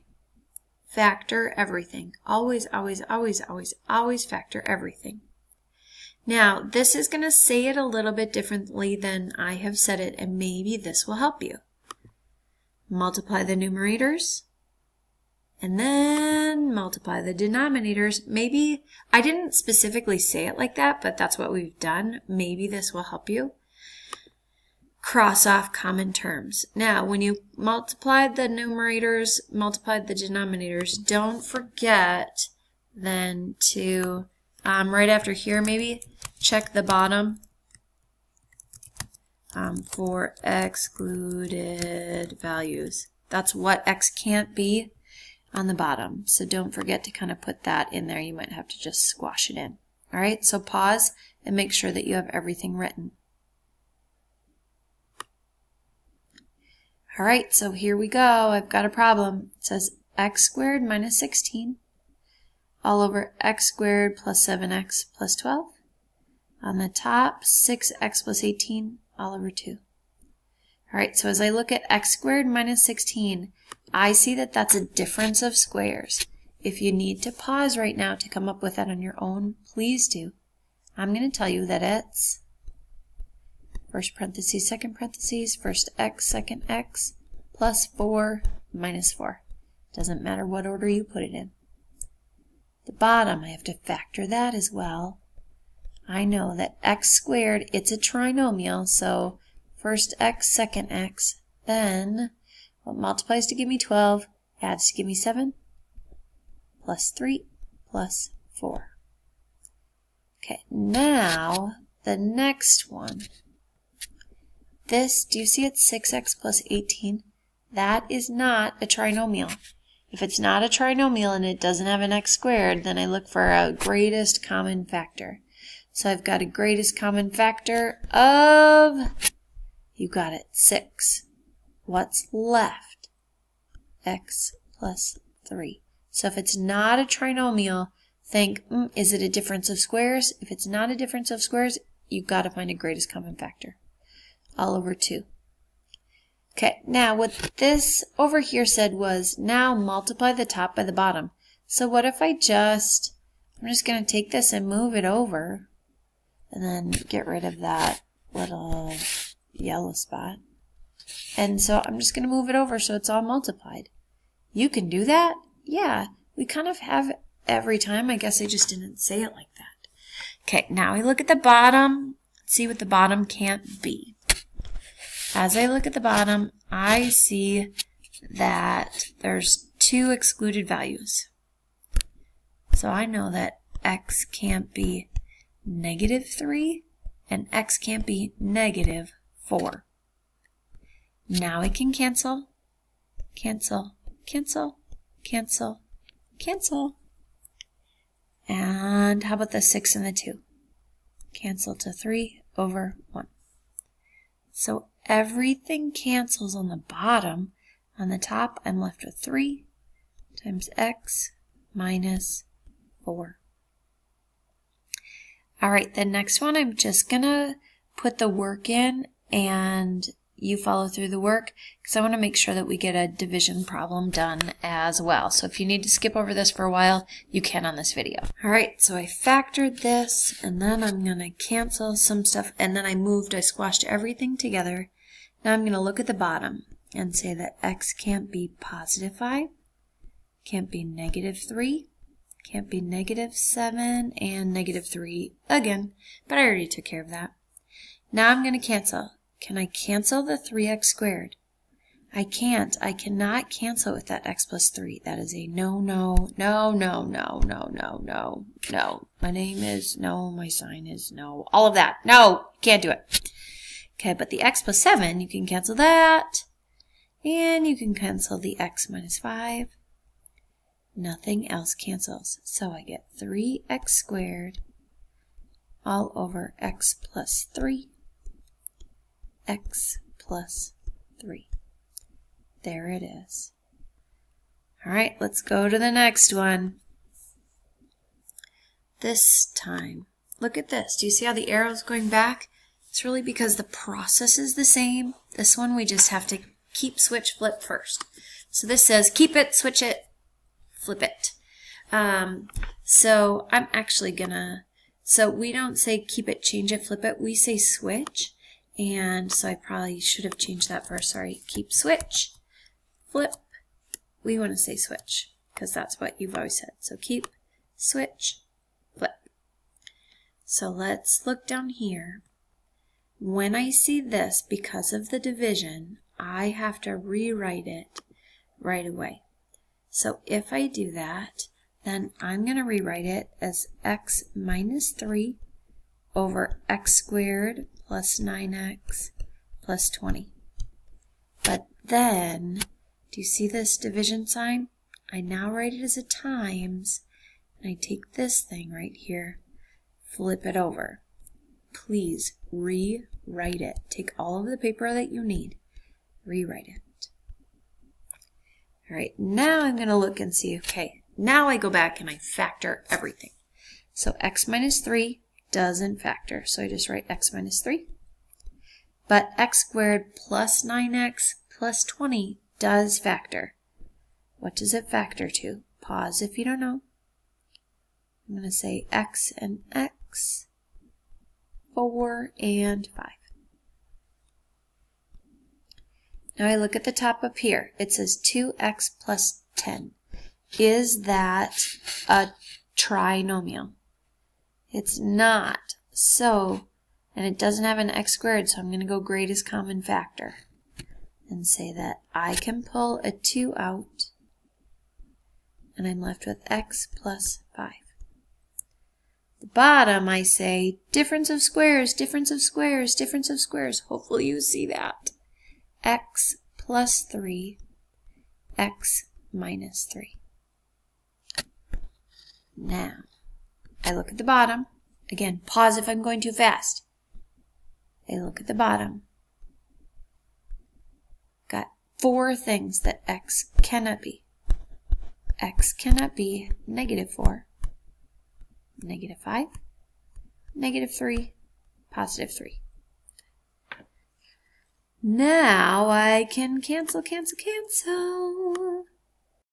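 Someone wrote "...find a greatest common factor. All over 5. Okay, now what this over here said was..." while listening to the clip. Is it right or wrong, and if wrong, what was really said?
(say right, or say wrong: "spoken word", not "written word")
wrong: "2", not "5".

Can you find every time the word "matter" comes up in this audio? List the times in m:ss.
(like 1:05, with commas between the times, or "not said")
1:30.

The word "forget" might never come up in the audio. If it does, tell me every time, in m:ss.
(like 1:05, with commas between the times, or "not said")
0:31, 0:46.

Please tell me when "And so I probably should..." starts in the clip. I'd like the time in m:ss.
5:08.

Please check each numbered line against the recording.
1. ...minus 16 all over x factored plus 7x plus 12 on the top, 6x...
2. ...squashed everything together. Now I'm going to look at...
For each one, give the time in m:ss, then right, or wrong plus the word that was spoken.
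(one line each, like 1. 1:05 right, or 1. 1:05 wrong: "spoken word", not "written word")
1. 1:00 wrong: "squared", not "factored"
2. 3:53 right.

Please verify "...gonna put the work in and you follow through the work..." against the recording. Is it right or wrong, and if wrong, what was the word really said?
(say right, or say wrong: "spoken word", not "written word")
right.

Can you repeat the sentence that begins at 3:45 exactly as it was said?
So if you need to skip over this for a while, you can on this video.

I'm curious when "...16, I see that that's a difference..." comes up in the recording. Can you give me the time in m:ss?
1:12.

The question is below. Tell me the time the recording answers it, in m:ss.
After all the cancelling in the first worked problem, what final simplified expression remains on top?
3:29.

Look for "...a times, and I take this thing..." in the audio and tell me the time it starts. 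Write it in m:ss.
5:45.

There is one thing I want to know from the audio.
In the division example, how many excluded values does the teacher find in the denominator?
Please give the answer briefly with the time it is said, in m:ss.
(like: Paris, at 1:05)
4, at 7:11.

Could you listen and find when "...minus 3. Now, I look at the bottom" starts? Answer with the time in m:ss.
6:59.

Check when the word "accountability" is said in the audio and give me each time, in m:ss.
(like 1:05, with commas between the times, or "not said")
not said.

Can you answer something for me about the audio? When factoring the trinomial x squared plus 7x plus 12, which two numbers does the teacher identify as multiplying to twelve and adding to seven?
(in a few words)
plus 3, plus 4.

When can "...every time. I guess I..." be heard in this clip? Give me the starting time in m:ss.
2:47.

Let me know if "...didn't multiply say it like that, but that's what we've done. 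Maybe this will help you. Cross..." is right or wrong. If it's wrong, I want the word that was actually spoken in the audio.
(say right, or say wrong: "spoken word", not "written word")
wrong: "specifically", not "multiply".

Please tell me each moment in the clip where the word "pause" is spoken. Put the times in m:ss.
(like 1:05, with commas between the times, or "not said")
0:50, 1:17, 6:15, 7:05.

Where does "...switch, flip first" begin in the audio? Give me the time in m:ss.
4:56.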